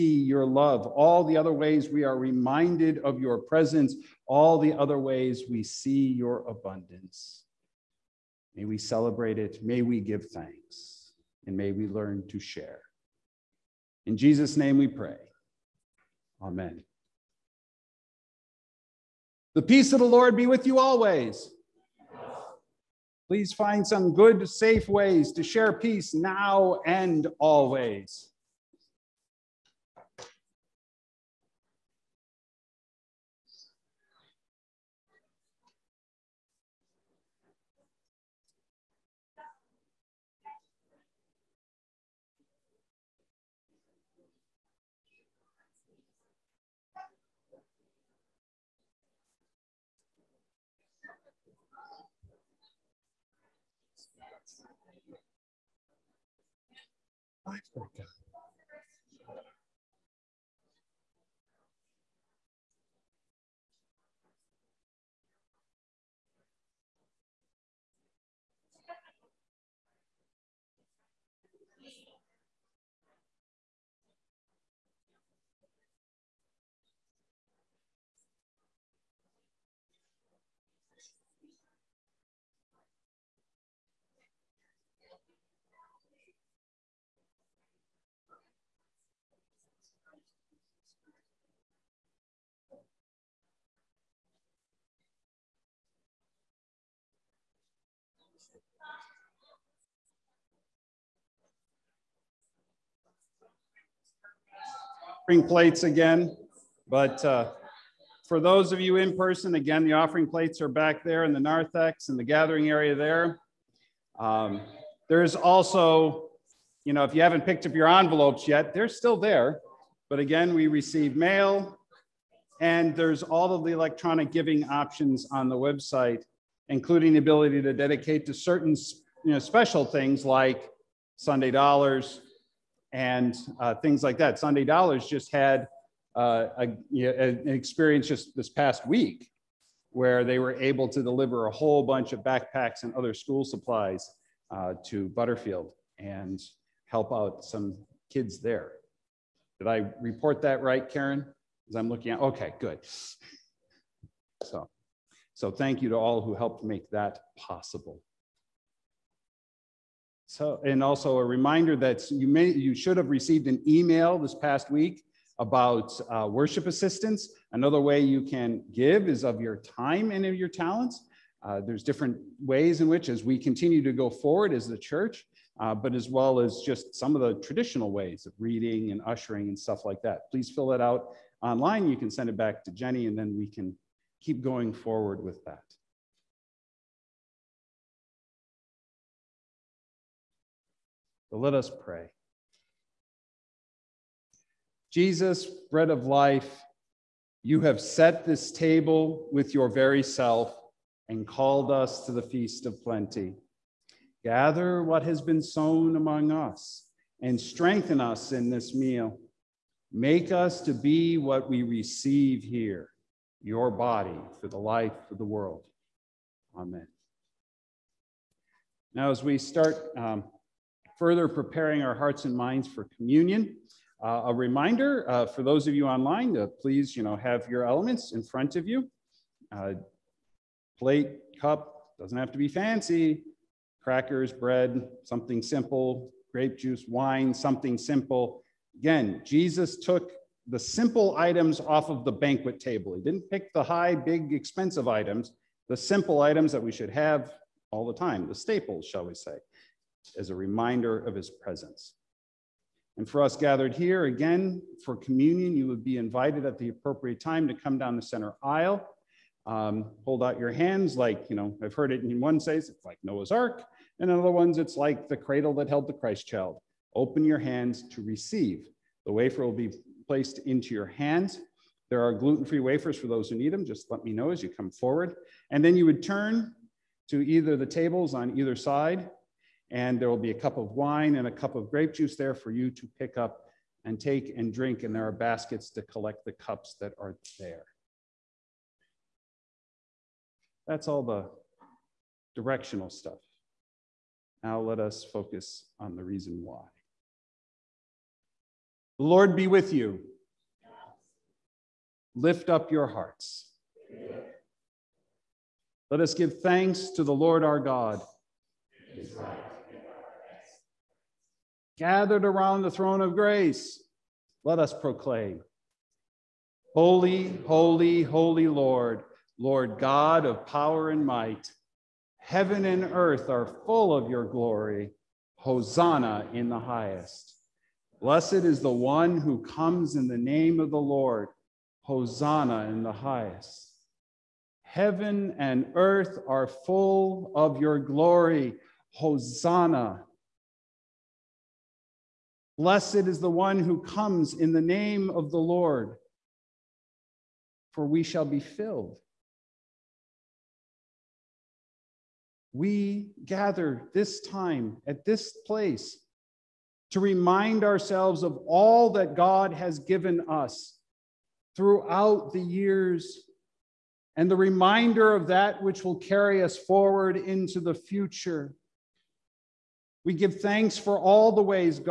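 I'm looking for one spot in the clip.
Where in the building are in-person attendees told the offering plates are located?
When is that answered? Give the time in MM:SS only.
01:51.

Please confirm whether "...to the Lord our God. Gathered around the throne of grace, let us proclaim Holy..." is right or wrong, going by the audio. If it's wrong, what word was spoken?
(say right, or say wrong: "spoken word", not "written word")
right.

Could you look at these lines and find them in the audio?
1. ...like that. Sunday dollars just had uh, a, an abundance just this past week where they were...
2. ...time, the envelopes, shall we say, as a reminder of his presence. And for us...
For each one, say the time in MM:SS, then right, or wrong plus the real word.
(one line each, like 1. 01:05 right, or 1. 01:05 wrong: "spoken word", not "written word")
1. 02:14 wrong: "experience", not "abundance"
2. 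04:07 wrong: "staples", not "envelopes".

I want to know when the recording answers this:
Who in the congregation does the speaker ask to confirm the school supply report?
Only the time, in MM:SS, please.
02:30.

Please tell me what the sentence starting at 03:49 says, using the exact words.
Uh, plate, cup, doesn't have to be fancy.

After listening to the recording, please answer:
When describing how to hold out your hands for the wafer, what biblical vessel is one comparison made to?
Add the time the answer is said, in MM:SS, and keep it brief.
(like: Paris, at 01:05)
Noah's Ark, at 04:23.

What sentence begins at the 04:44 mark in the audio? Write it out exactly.
And there are baskets to collect the cups that are there.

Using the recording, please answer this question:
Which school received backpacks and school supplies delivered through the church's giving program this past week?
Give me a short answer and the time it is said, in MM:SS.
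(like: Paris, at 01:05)
Butterfield, at 02:25.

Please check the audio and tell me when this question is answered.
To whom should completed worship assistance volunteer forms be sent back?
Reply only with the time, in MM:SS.
03:02.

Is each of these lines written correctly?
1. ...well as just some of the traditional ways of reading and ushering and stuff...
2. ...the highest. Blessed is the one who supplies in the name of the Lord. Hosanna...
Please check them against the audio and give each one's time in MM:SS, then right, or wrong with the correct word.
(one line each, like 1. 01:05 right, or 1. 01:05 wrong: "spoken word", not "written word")
1. 02:56 right
2. 05:26 wrong: "comes", not "supplies".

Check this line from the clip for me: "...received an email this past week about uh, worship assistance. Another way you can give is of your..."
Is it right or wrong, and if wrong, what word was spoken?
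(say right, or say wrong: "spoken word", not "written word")
right.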